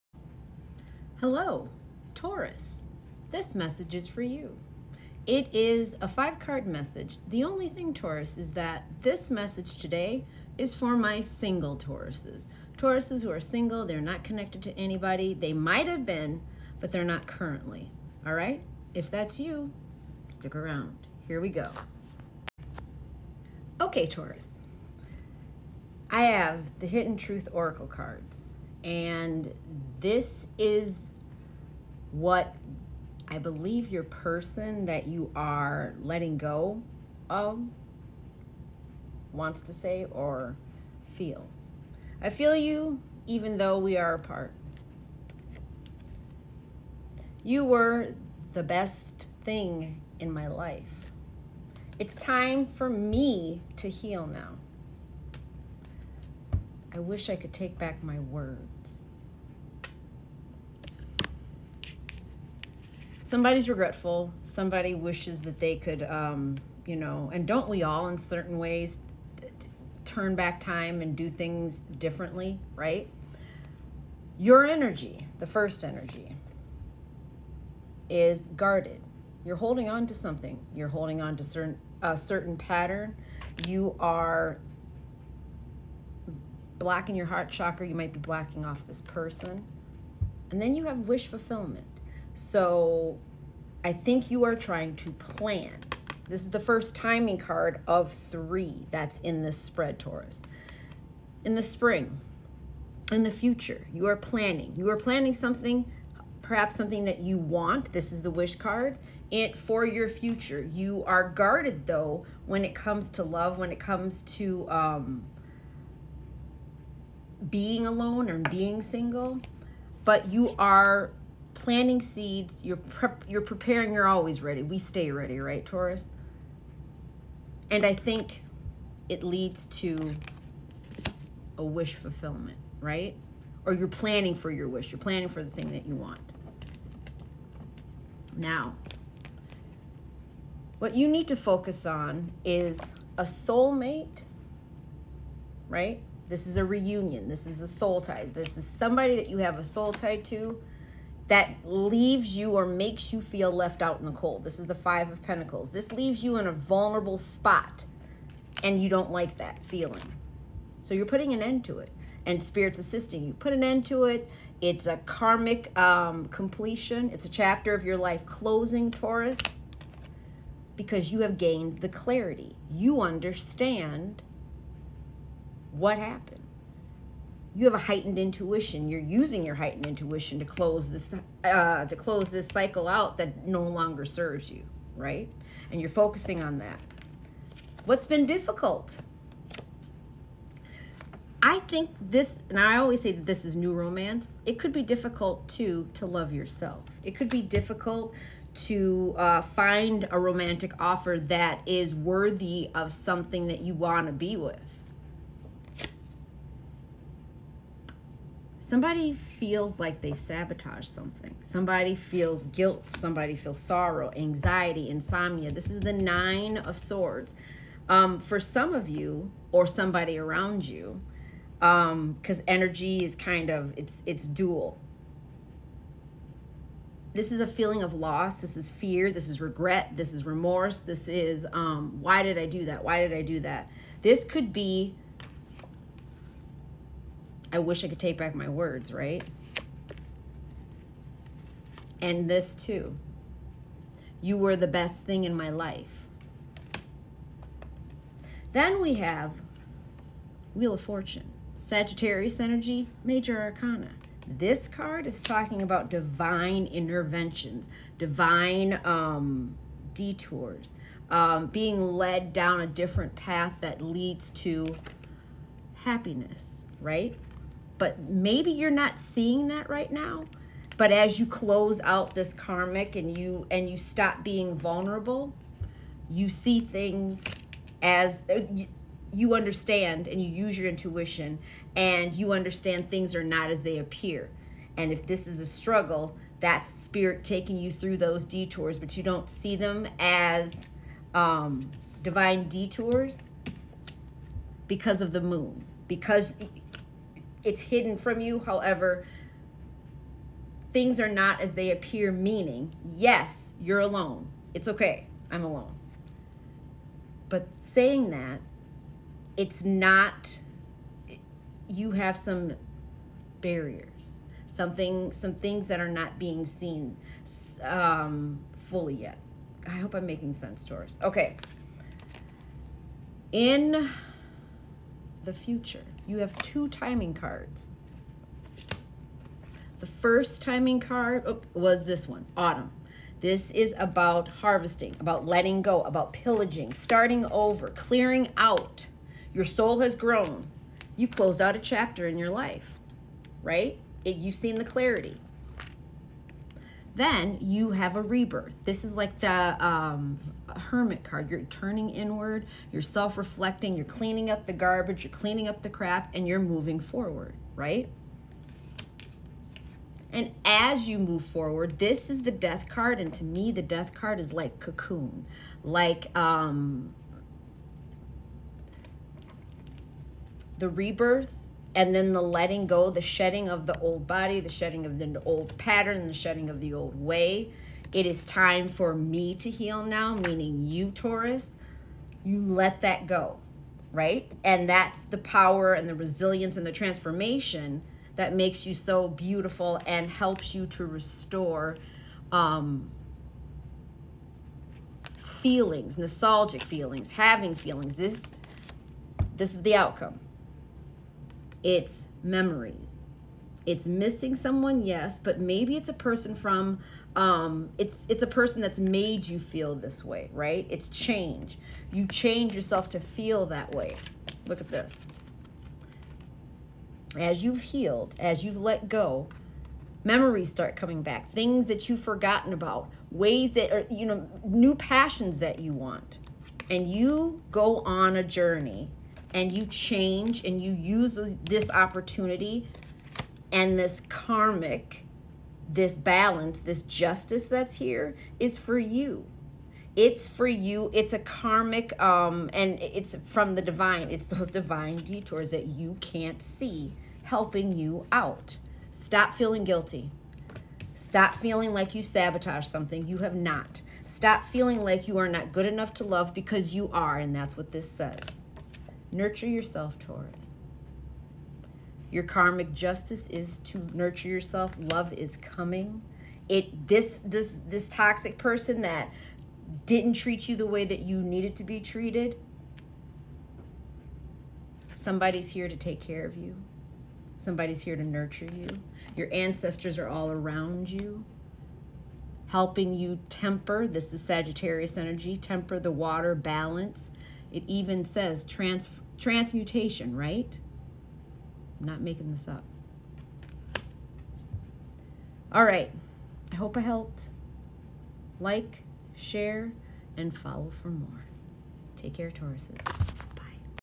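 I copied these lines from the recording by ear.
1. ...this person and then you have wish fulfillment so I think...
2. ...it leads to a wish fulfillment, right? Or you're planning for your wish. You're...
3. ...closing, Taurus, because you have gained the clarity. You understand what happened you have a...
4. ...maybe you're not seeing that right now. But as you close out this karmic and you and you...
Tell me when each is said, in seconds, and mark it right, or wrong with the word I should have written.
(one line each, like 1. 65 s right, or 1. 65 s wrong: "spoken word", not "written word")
1. 88 s right
2. 129 s right
3. 168 s right
4. 267 s right.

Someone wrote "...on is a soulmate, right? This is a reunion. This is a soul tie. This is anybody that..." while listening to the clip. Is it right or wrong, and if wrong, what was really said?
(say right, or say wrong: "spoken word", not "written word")
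wrong: "somebody", not "anybody".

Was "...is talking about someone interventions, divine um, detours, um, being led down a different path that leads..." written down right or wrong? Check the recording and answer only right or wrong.
wrong.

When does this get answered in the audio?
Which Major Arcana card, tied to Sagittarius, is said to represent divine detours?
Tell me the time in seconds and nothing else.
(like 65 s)
250 s.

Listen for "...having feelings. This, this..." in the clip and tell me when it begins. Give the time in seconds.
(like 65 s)
397 s.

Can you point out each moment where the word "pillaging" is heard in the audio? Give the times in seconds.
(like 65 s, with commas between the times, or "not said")
336 s.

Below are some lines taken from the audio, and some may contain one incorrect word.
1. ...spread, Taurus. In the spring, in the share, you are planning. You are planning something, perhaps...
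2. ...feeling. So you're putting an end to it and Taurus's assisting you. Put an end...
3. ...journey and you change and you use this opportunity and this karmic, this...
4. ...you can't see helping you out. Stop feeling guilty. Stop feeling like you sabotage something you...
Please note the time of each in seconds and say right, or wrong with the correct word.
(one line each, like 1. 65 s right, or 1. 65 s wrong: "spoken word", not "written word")
1. 99 s wrong: "future", not "share"
2. 159 s wrong: "Spirit", not "Taurus"
3. 428 s right
4. 445 s right.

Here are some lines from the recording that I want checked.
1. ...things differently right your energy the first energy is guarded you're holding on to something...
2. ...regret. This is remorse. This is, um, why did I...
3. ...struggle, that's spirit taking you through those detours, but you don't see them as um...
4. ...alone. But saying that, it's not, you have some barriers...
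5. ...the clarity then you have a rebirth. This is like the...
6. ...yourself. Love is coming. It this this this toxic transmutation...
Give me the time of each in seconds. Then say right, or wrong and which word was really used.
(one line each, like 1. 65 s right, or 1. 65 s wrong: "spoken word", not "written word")
1. 71 s right
2. 229 s right
3. 285 s right
4. 305 s right
5. 344 s right
6. 464 s wrong: "person", not "transmutation".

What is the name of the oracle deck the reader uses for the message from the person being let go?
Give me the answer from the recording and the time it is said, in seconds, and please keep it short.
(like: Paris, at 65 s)
Hidden Truth Oracle, at 26 s.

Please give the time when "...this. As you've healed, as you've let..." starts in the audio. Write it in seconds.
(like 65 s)
414 s.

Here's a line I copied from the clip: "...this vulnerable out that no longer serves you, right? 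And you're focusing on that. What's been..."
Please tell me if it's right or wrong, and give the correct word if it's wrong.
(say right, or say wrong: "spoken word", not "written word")
wrong: "cycle", not "vulnerable".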